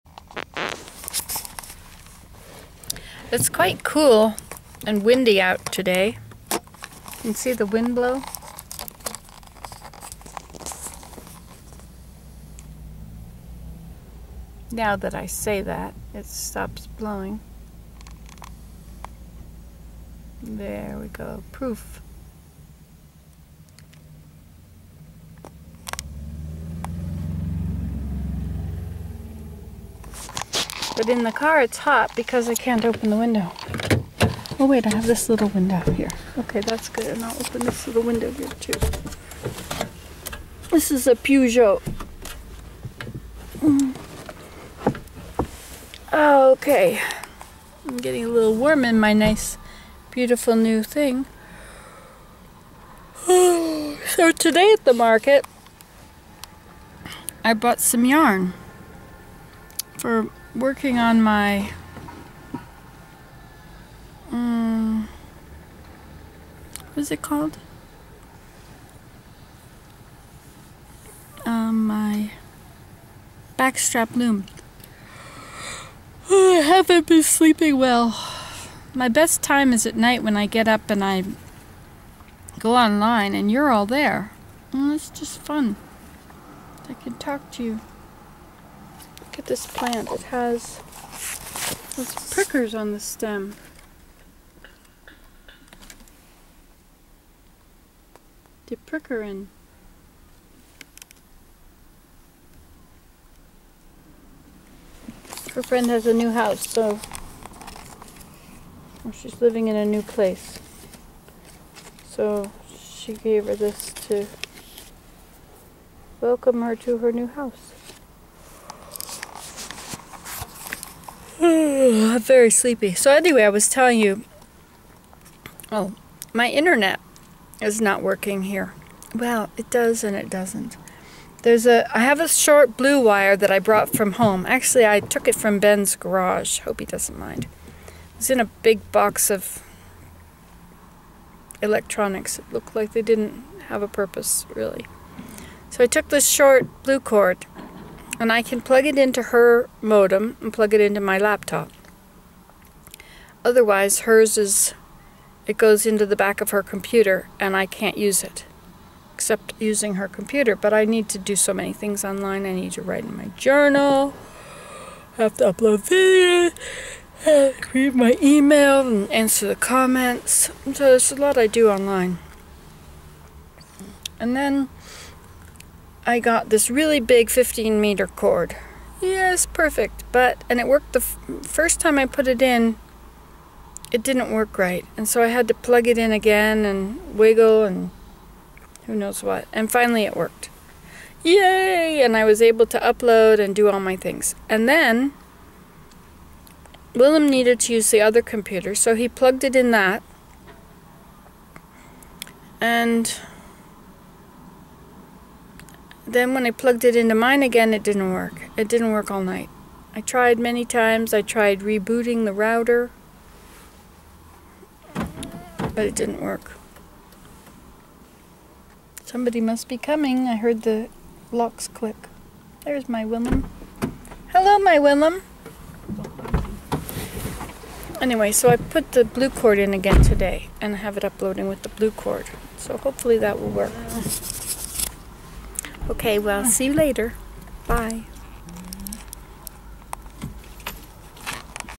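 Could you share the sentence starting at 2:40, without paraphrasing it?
But I need to do so many things online.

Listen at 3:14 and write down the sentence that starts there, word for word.
And then Willem needed to use the other computer, so he plugged it in that.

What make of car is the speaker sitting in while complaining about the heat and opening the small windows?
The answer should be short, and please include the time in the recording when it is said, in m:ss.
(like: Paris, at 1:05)
Peugeot, at 0:41.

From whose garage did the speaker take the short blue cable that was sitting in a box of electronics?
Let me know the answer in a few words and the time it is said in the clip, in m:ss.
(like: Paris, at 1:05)
Ben's, at 2:15.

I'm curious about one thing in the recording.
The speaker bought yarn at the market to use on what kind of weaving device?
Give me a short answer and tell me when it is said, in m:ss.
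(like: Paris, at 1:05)
backstrap loom, at 1:13.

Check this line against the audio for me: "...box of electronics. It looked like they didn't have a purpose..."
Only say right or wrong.
right.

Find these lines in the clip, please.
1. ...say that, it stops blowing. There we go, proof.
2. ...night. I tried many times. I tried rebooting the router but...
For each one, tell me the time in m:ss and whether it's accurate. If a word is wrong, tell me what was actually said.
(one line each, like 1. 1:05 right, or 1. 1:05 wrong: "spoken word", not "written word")
1. 0:15 right
2. 3:29 right.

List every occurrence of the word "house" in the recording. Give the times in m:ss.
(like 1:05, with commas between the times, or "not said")
1:46, 1:57.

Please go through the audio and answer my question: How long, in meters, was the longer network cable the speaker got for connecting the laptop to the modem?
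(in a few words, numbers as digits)
15 meters.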